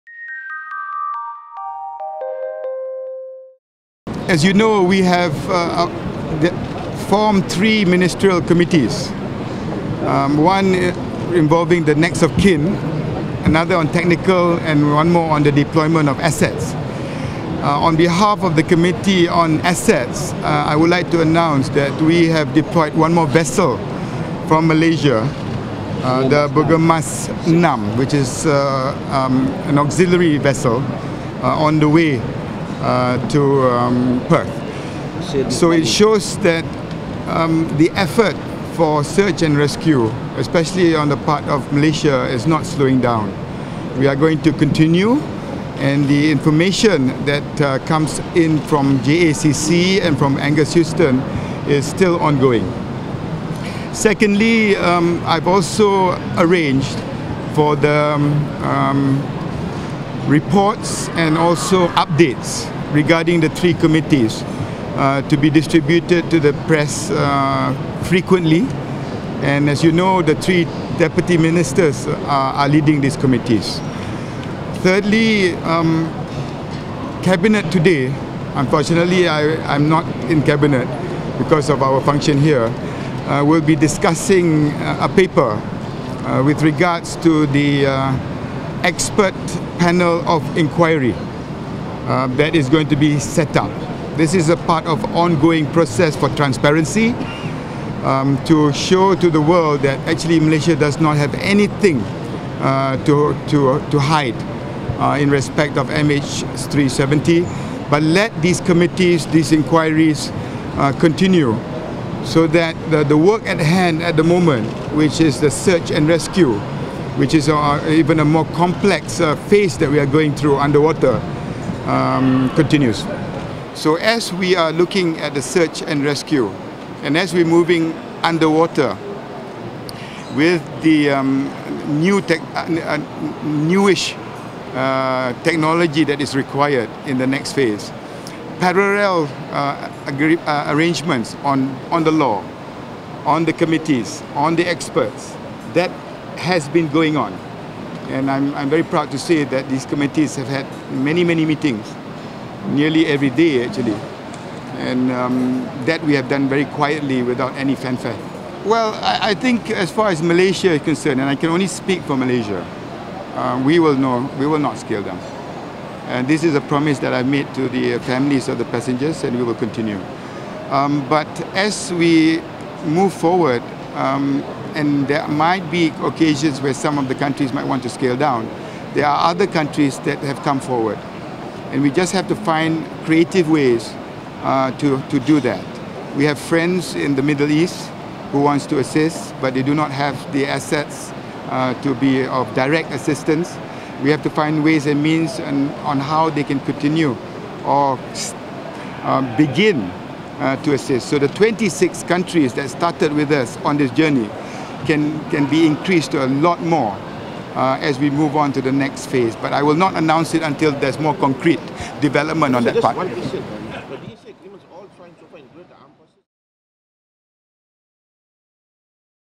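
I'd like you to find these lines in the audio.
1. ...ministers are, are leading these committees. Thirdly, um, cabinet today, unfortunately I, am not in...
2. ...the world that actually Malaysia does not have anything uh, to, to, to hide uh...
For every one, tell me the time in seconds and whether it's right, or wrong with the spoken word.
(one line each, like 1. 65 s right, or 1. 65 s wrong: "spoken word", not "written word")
1. 71 s right
2. 99 s right.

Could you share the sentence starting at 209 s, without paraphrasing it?
But I will not announce it until there's more concrete development on so that part.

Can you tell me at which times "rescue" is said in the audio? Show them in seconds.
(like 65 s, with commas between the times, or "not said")
39 s, 116 s, 126 s.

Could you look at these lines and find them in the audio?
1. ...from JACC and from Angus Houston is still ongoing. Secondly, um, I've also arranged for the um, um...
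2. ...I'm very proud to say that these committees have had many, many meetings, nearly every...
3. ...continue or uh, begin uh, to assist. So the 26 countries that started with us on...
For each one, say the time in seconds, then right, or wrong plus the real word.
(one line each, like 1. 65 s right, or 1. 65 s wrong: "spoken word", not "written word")
1. 48 s right
2. 148 s right
3. 196 s right.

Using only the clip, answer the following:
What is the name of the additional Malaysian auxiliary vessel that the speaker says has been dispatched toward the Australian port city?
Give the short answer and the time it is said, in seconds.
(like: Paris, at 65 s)
Bergemas Nam, at 26 s.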